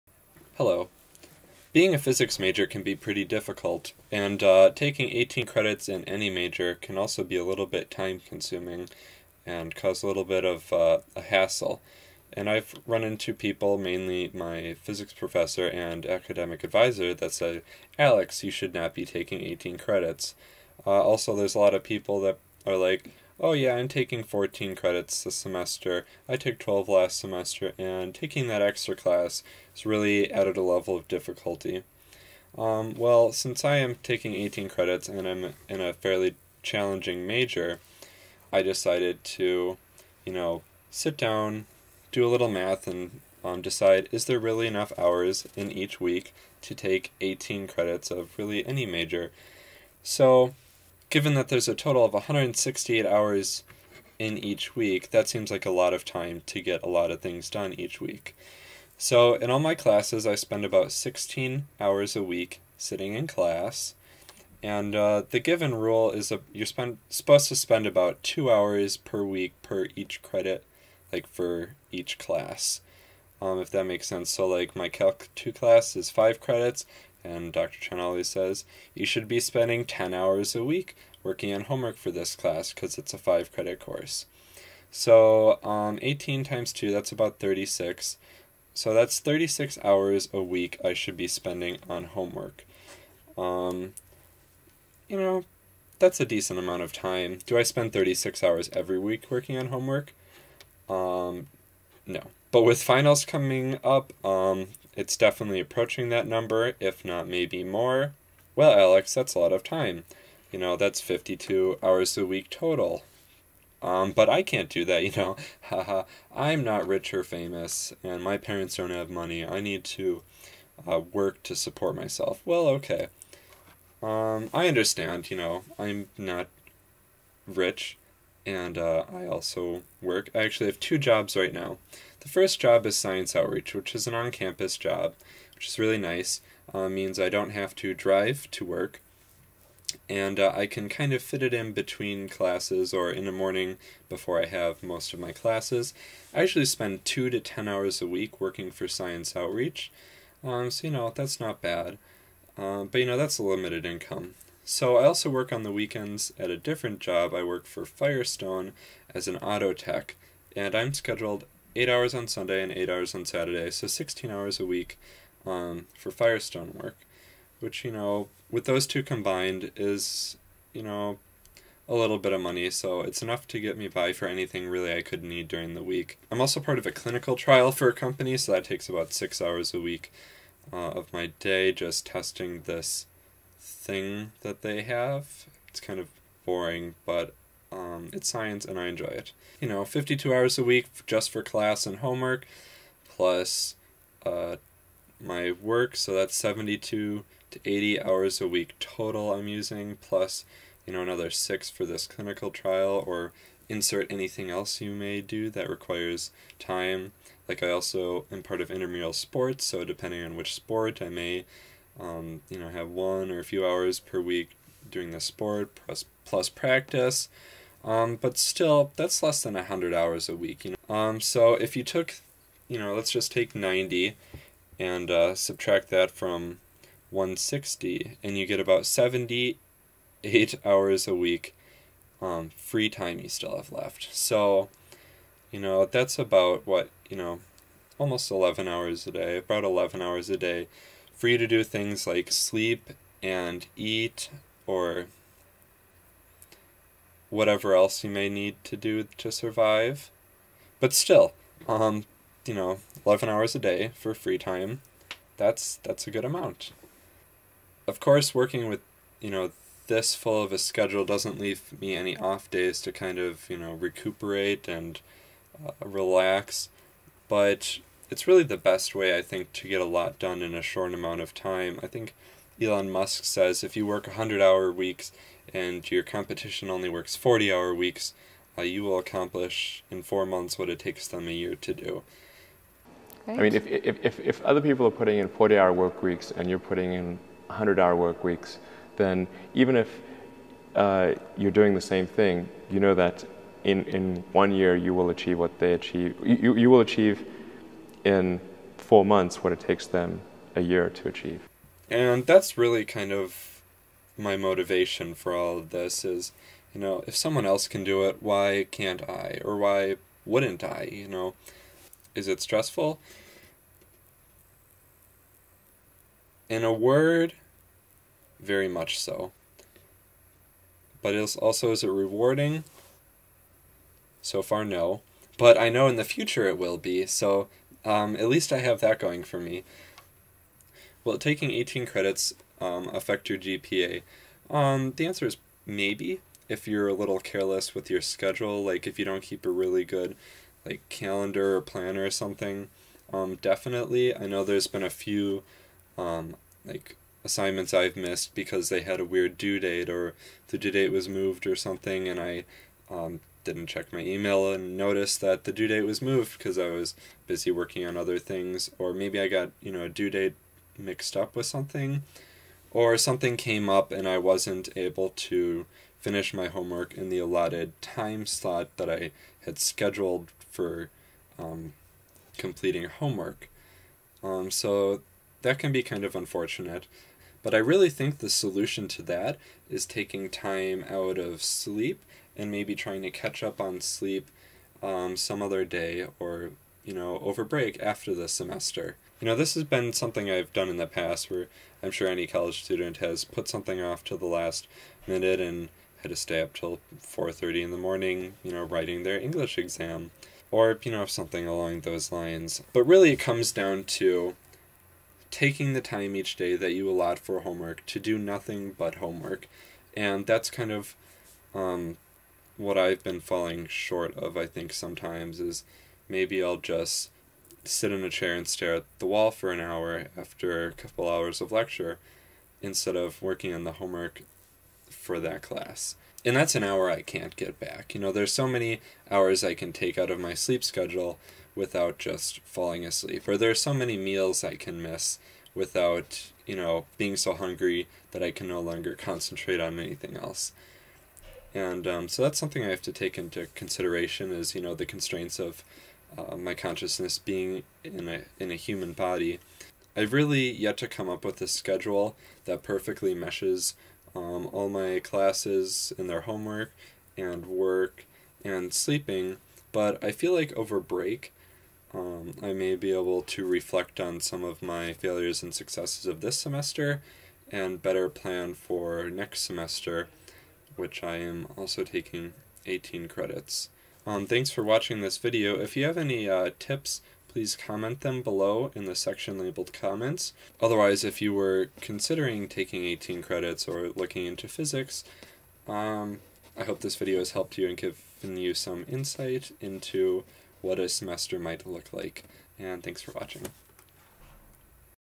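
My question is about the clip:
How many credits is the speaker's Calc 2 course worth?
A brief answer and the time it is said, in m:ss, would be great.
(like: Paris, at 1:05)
5, at 1:16.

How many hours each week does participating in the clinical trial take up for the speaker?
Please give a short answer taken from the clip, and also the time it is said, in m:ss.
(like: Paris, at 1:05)
6, at 2:59.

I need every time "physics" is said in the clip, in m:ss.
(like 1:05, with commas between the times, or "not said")
0:01, 0:14, 8:04.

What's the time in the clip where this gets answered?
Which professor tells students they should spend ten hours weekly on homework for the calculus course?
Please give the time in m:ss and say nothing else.
1:17.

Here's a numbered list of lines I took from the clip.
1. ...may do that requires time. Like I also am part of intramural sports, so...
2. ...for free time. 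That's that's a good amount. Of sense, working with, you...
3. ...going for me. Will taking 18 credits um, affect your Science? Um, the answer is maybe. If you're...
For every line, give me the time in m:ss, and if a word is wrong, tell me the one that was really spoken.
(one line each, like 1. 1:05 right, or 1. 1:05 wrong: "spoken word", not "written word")
1. 3:24 right
2. 4:13 wrong: "course", not "sense"
3. 5:28 wrong: "GPA", not "Science".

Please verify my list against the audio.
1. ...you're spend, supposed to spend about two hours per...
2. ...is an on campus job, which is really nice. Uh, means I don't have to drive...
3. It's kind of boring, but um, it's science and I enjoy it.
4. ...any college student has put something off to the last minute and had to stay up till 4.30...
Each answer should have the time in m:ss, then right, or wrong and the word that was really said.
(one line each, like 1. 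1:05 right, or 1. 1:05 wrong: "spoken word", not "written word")
1. 1:06 right
2. 2:13 right
3. 3:05 right
4. 6:32 right.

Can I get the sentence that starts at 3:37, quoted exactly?
Um, but still, that's less than 100 hours a week.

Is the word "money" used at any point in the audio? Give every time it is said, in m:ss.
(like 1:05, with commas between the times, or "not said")
1:59, 2:52.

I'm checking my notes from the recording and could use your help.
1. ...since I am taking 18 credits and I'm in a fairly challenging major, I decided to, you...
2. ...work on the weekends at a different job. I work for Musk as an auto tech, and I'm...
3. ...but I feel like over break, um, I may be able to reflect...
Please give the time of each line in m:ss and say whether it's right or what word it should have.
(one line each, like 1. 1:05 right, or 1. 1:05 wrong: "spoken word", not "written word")
1. 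0:33 right
2. 2:35 wrong: "Firestone", not "Musk"
3. 7:39 right.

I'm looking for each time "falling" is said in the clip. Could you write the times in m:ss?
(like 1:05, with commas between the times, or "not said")
6:53, 7:12.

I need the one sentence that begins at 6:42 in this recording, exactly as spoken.
But really it comes down to taking the time each day that you allot for homework to do nothing but homework.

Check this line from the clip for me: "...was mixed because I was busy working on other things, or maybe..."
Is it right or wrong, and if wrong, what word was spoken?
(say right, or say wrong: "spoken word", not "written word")
wrong: "moved", not "mixed".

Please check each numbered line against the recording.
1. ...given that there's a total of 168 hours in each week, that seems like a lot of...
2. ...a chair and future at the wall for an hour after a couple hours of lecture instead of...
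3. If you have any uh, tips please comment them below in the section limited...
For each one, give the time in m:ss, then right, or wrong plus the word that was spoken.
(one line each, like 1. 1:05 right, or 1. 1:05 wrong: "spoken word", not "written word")
1. 0:51 right
2. 6:58 wrong: "stare", not "future"
3. 7:55 wrong: "labeled", not "limited".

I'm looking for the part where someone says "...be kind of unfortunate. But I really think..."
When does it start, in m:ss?
6:15.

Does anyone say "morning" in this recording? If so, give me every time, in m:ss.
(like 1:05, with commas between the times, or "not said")
2:23, 6:37.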